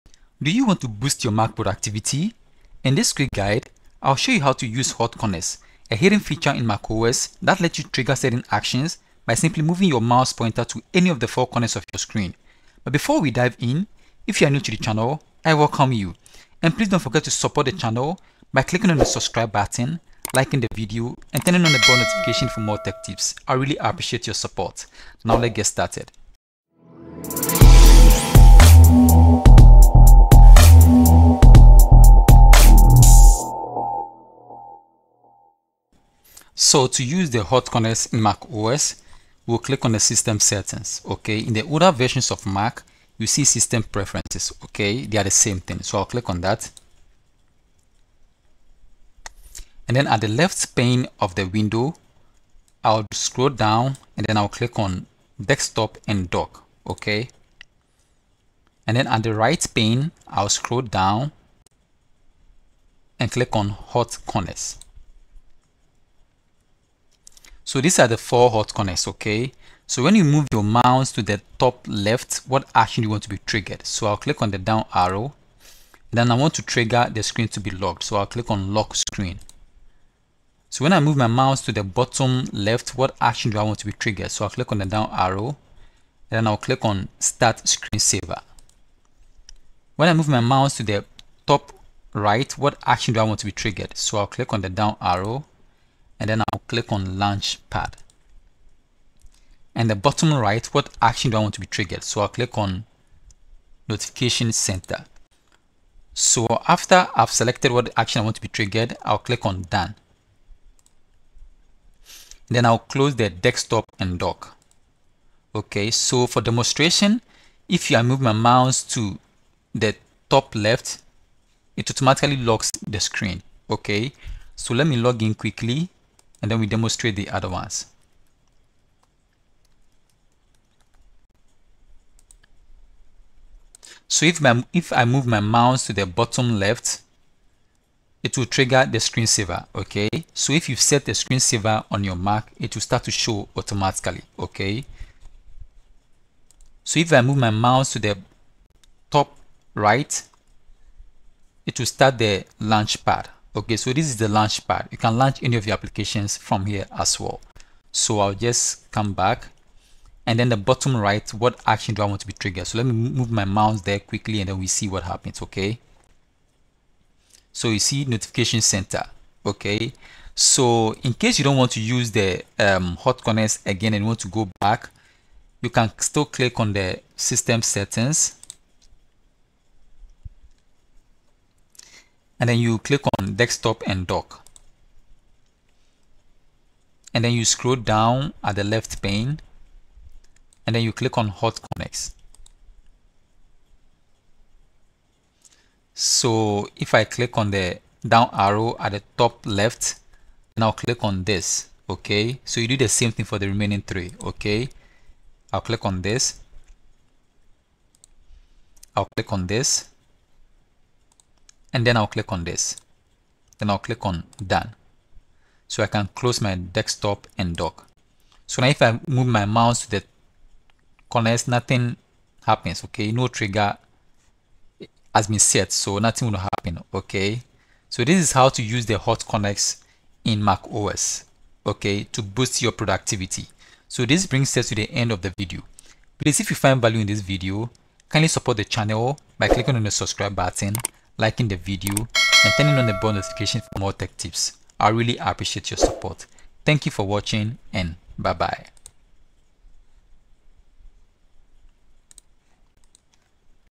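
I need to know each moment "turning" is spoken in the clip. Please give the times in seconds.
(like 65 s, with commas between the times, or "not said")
21 s, 242 s.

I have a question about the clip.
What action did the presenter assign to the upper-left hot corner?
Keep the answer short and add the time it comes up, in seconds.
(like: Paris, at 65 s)
Lock screen, at 78 s.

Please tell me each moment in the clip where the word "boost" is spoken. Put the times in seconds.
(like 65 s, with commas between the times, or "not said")
0 s, 232 s.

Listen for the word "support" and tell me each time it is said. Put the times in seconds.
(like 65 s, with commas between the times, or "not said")
17 s, 24 s, 238 s, 245 s.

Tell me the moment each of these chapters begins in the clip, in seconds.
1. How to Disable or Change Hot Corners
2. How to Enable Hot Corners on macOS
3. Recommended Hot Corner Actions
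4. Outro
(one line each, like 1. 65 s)
1. 140 s
2. 35 s
3. 75 s
4. 190 s.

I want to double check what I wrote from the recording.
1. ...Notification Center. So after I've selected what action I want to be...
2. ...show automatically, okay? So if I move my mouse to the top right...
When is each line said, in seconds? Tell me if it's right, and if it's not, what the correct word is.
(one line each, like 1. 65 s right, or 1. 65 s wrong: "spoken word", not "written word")
1. 103 s right
2. 143 s right.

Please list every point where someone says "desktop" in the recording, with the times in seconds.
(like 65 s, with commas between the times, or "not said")
55 s, 113 s, 183 s, 216 s.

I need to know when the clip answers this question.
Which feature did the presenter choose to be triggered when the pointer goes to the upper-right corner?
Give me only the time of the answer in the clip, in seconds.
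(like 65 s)
97 s.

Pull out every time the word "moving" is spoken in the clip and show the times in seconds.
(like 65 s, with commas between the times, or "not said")
9 s.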